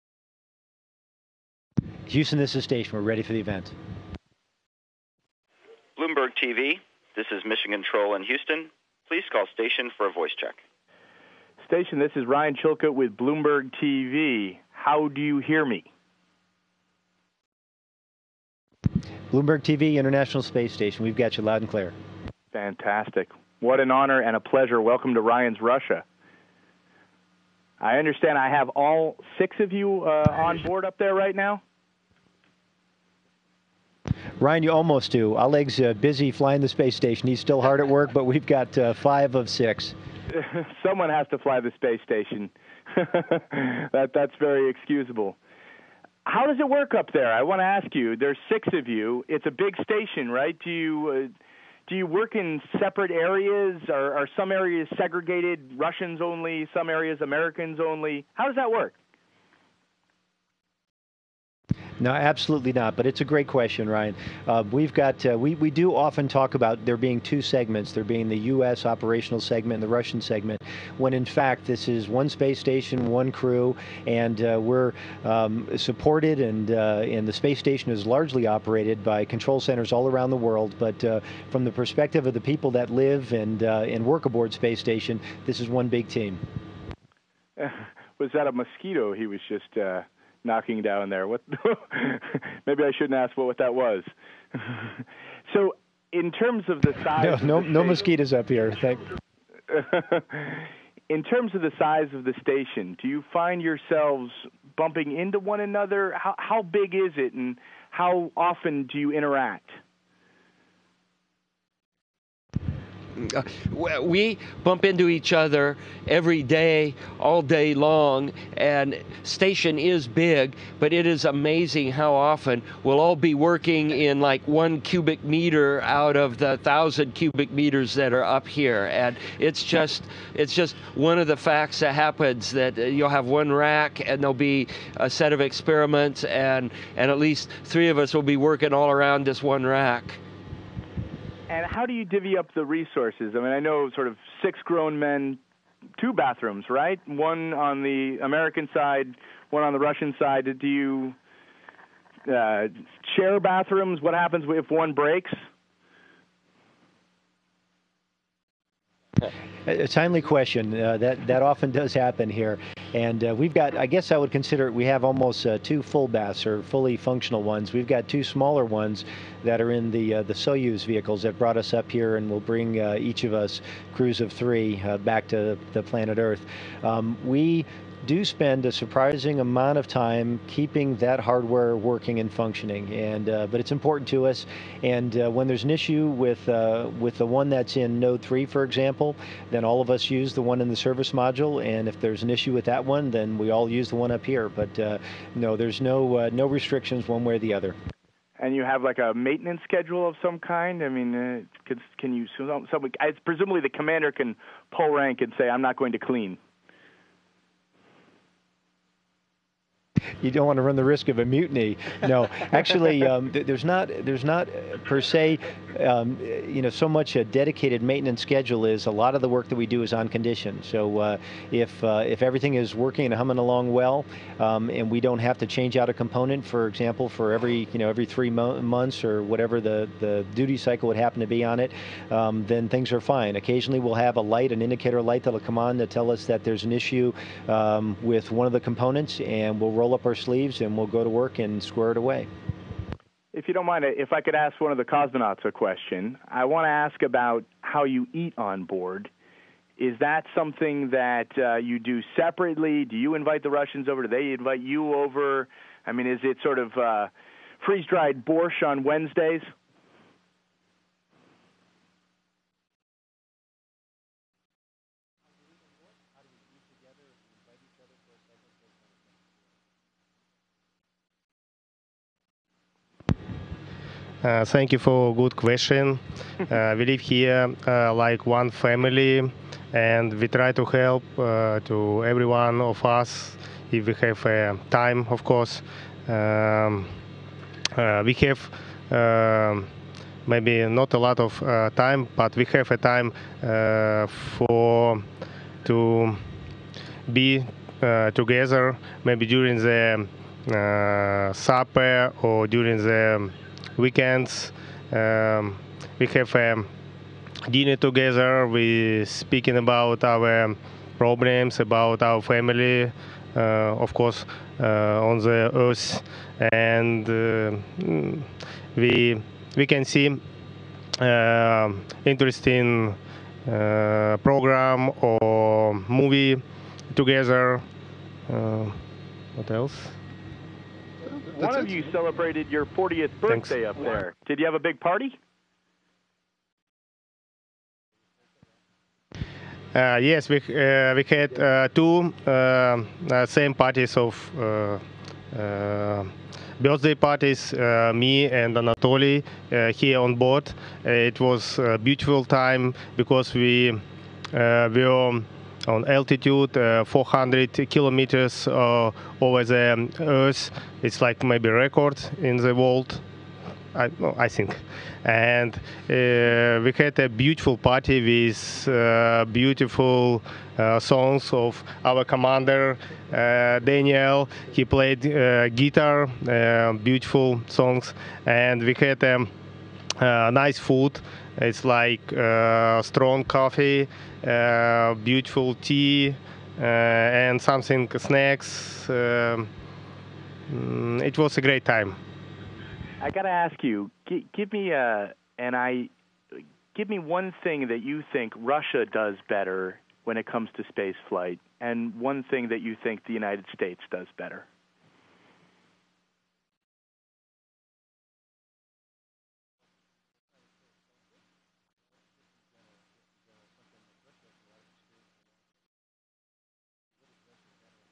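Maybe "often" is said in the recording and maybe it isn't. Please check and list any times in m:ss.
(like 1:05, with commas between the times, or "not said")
1:05, 1:48, 2:02, 2:41.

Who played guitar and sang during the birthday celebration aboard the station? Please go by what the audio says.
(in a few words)
Daniel.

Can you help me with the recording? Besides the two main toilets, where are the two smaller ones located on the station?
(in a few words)
Soyuz vehicles.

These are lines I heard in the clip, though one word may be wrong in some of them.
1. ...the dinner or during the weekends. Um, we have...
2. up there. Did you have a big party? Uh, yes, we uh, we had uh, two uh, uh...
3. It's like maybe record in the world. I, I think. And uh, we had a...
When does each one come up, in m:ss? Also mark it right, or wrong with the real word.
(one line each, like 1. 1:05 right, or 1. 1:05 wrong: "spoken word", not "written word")
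1. 4:59 wrong: "supper", not "dinner"
2. 5:33 right
3. 6:00 right.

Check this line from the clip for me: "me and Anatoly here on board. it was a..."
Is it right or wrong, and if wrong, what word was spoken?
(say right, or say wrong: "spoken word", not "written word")
right.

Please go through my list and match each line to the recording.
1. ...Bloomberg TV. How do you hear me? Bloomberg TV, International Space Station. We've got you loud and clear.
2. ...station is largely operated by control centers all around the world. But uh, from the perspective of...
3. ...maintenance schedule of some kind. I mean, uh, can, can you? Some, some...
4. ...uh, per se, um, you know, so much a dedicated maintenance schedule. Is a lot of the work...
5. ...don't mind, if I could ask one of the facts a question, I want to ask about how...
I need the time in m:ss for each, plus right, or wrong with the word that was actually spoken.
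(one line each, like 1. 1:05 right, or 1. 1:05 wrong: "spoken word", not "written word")
1. 0:13 right
2. 1:17 right
3. 3:19 right
4. 3:34 right
5. 4:03 wrong: "cosmonauts", not "facts".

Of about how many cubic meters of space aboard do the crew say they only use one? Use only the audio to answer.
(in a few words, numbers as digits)
1000.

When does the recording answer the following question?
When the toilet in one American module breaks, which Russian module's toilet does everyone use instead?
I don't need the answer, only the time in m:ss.
3:10.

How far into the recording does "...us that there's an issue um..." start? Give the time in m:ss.
3:56.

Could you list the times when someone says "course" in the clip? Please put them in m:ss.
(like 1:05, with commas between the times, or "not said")
4:45, 5:13.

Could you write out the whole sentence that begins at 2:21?
And how do you divvy up the resources?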